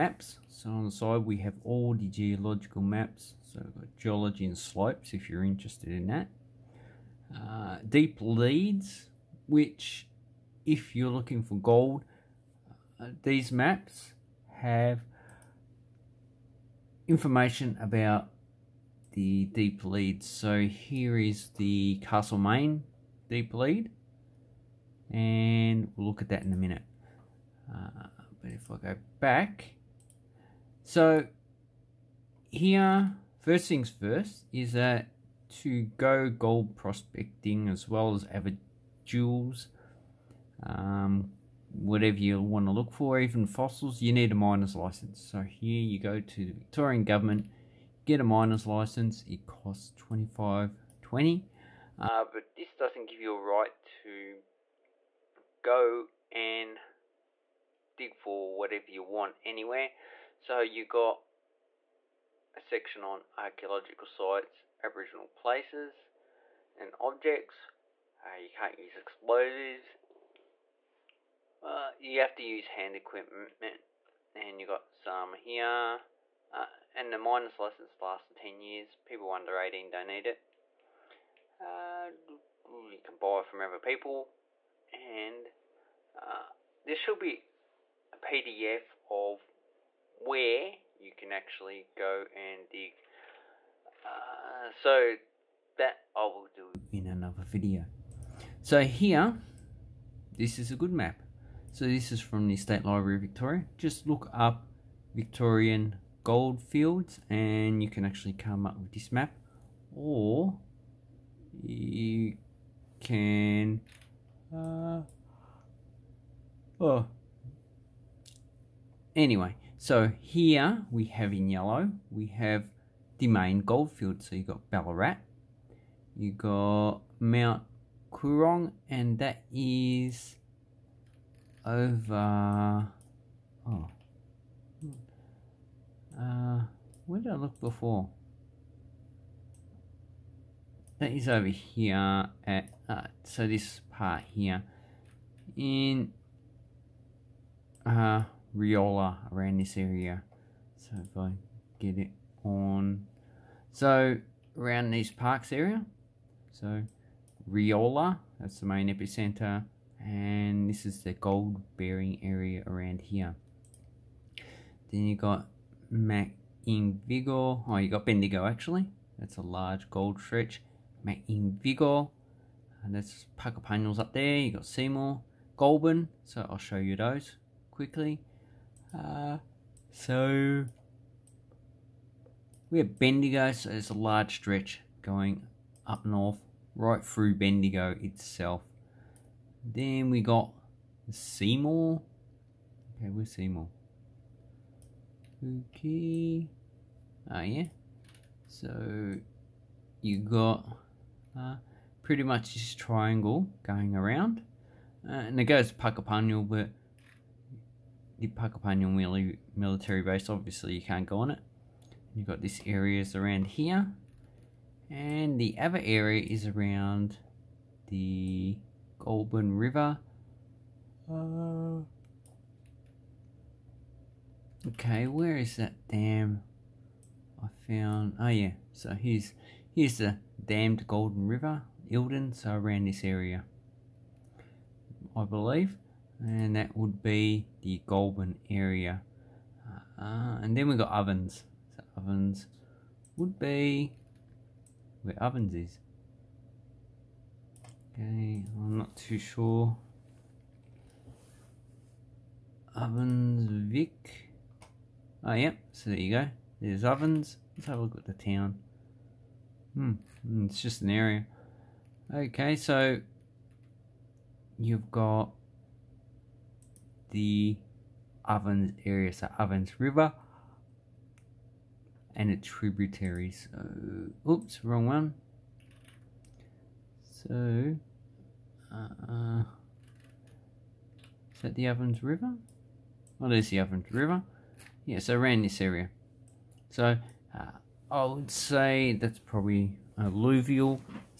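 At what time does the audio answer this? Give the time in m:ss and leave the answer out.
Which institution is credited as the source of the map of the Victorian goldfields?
1:42.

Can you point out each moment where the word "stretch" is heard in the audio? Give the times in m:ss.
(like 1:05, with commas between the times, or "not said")
2:50, 3:04.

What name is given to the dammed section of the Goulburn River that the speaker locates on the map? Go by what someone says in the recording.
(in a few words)
Eildon.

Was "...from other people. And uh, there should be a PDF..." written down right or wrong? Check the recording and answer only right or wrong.
right.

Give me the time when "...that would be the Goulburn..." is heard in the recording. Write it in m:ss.
3:56.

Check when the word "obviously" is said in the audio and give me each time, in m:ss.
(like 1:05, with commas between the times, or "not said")
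3:30.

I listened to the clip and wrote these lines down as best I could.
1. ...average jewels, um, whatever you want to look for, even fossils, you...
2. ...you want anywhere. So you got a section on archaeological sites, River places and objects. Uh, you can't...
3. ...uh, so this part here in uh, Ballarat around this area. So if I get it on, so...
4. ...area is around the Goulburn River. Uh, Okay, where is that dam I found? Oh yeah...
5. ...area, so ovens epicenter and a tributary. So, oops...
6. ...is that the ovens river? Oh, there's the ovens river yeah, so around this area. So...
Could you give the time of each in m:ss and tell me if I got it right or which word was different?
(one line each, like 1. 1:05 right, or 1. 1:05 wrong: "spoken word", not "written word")
1. 0:38 right
2. 0:58 wrong: "Aboriginal", not "River"
3. 2:22 wrong: "Riola", not "Ballarat"
4. 3:35 right
5. 4:28 wrong: "river", not "epicenter"
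6. 4:41 right.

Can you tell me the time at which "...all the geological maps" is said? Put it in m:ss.
0:01.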